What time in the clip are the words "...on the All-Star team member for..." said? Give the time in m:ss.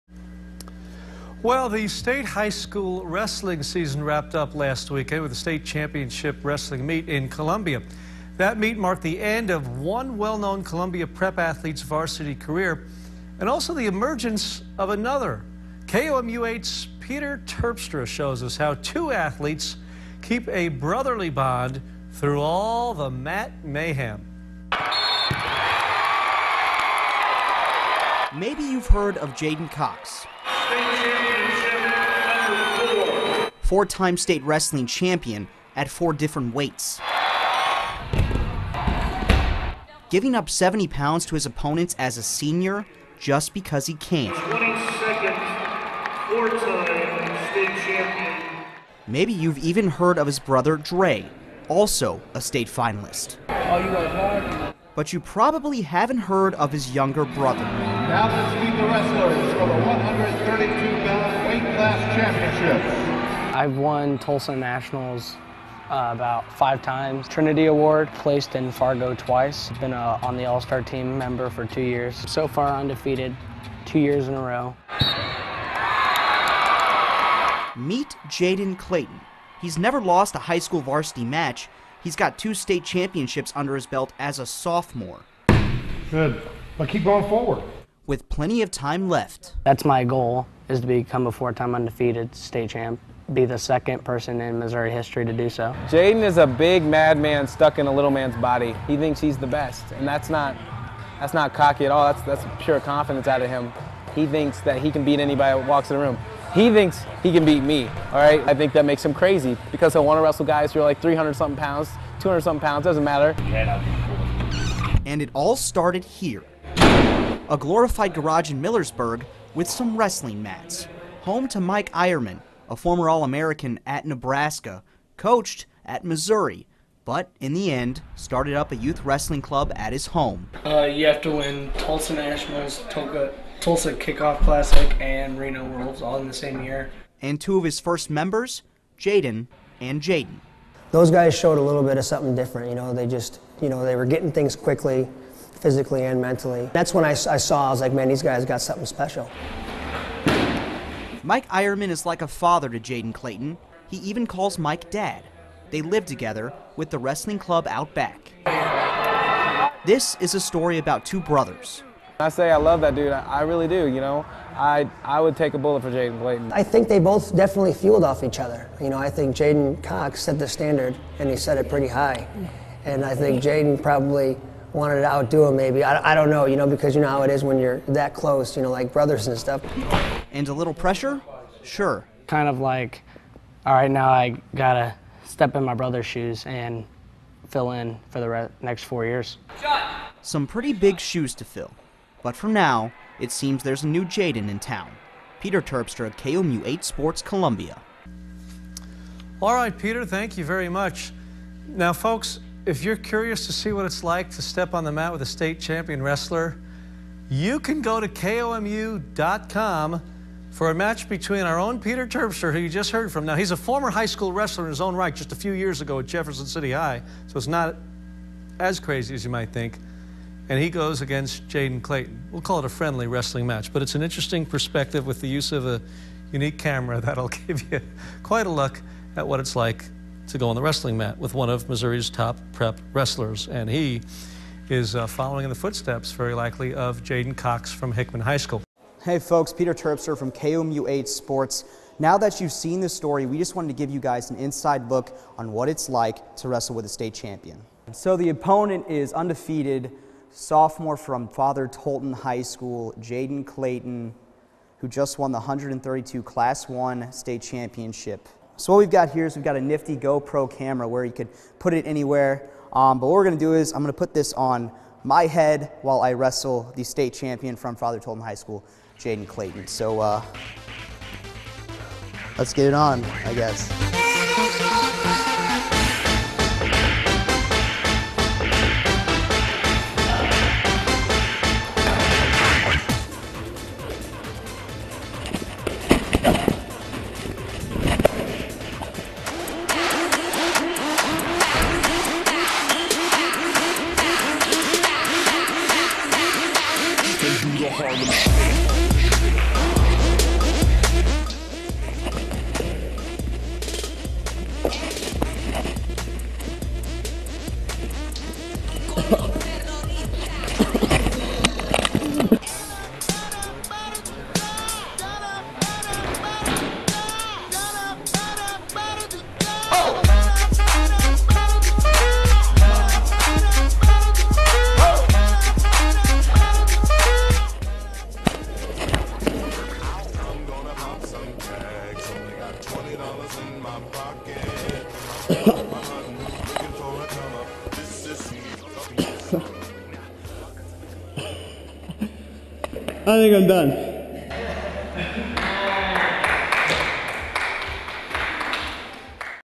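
1:10.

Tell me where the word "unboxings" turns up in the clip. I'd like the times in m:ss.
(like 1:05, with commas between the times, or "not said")
not said.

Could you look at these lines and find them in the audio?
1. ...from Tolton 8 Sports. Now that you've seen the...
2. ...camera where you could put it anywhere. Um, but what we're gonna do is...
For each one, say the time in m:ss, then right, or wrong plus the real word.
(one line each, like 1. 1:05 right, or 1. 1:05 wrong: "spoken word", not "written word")
1. 4:00 wrong: "KOMU", not "Tolton"
2. 4:20 right.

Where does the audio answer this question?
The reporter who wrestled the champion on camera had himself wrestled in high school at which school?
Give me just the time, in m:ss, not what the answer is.
3:36.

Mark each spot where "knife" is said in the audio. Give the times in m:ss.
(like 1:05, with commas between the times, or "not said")
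not said.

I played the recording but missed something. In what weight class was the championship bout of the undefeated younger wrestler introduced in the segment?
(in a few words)
132 pound.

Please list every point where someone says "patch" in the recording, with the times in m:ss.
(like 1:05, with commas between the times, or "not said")
not said.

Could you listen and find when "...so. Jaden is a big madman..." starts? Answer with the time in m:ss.
1:35.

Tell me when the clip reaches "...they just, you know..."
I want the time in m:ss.
2:22.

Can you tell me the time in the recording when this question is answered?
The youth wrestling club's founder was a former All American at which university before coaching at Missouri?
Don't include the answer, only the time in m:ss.
2:04.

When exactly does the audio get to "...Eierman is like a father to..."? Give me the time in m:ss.
2:31.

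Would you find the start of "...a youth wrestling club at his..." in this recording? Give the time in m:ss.
2:08.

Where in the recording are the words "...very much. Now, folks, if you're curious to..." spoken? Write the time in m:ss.
3:20.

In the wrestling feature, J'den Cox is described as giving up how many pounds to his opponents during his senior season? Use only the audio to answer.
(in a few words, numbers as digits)
70 pounds.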